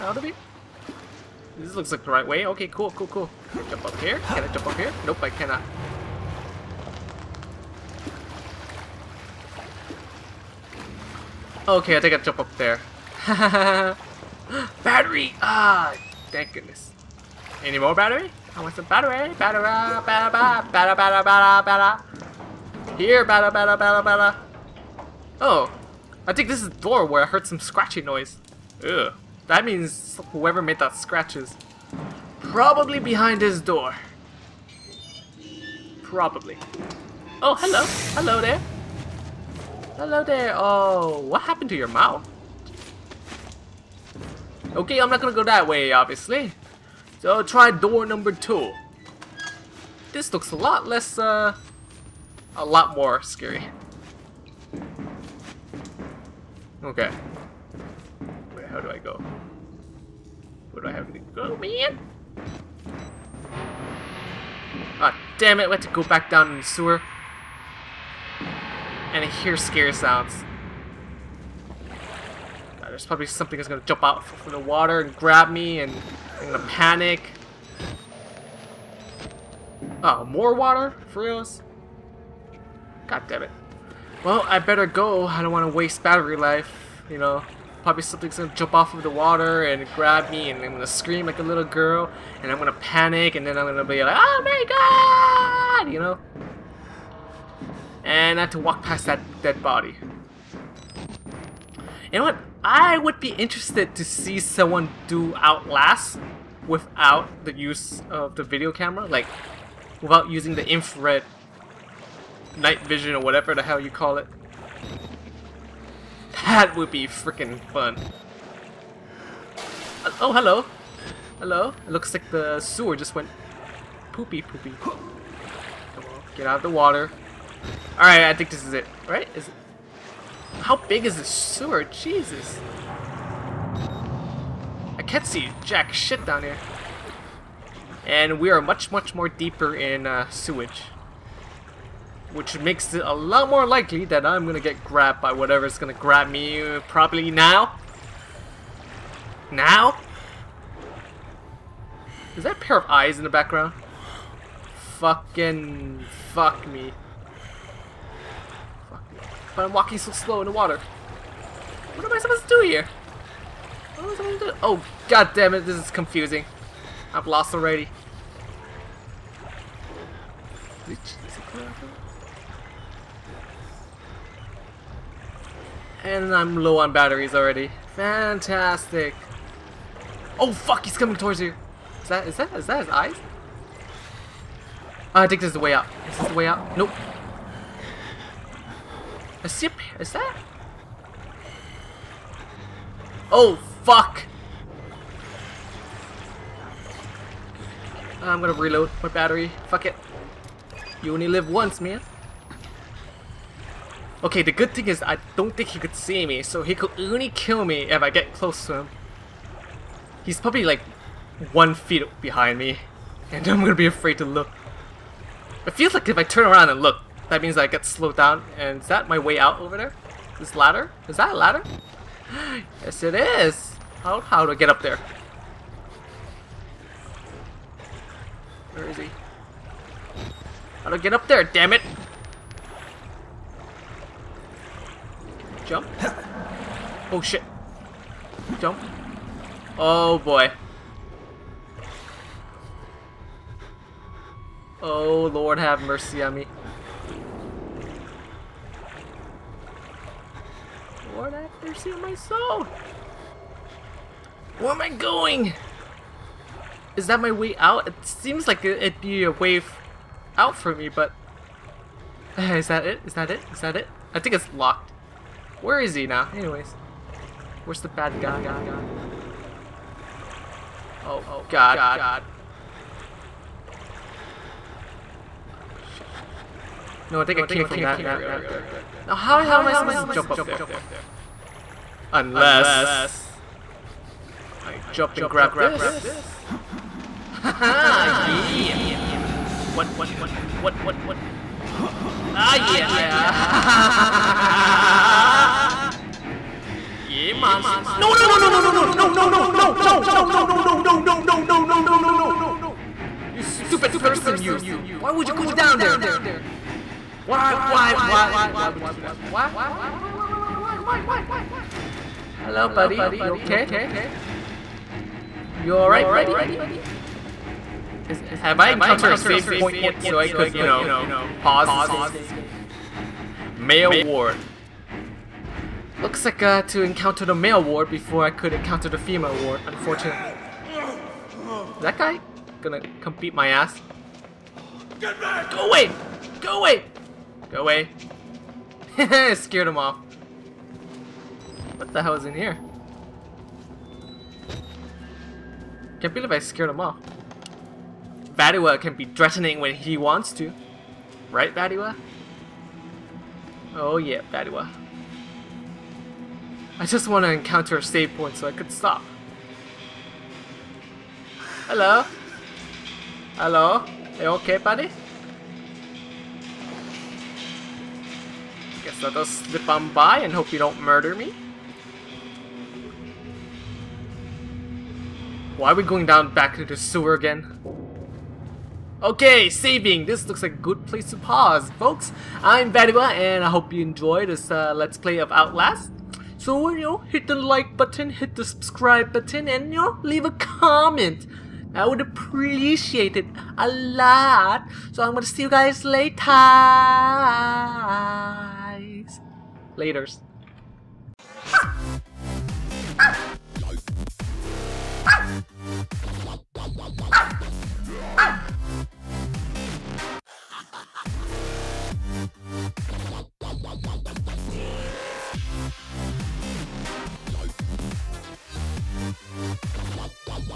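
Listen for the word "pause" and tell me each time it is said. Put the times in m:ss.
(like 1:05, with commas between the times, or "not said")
5:21, 6:21.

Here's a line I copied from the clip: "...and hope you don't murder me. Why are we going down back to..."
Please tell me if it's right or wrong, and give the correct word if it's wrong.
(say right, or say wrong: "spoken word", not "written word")
right.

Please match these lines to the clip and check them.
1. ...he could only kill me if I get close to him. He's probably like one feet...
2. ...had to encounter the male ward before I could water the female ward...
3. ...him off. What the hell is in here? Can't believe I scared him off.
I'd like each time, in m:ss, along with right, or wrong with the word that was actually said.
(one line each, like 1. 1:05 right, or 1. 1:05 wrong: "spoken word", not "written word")
1. 3:26 right
2. 5:26 wrong: "encounter", not "water"
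3. 5:39 right.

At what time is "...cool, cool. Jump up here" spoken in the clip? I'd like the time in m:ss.
0:02.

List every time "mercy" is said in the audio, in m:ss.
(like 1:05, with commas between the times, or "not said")
4:05.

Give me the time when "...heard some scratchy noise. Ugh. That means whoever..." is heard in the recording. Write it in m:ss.
0:27.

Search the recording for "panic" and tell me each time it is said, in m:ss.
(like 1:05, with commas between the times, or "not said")
1:16, 1:32.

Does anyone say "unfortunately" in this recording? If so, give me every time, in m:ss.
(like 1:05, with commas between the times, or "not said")
5:29.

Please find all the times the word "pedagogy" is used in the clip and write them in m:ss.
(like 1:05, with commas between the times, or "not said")
not said.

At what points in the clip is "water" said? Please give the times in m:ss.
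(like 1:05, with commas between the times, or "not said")
1:14, 1:20, 1:29, 2:06, 2:40.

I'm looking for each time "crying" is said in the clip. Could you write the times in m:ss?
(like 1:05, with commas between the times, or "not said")
not said.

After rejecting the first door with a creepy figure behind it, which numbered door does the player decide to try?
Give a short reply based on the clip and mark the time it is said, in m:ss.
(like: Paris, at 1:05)
Door number two, at 0:47.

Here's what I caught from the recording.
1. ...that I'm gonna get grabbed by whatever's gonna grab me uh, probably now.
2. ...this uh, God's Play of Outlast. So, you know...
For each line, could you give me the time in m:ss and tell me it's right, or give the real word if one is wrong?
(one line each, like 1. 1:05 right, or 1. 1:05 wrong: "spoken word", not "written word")
1. 2:24 right
2. 6:24 wrong: "Let", not "God".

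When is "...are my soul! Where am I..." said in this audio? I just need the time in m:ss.
4:11.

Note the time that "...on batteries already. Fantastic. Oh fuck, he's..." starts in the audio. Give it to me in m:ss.
2:56.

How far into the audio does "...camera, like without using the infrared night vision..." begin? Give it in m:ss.
1:48.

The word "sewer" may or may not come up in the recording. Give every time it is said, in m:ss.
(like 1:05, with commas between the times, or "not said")
1:06, 2:02, 2:11, 6:16.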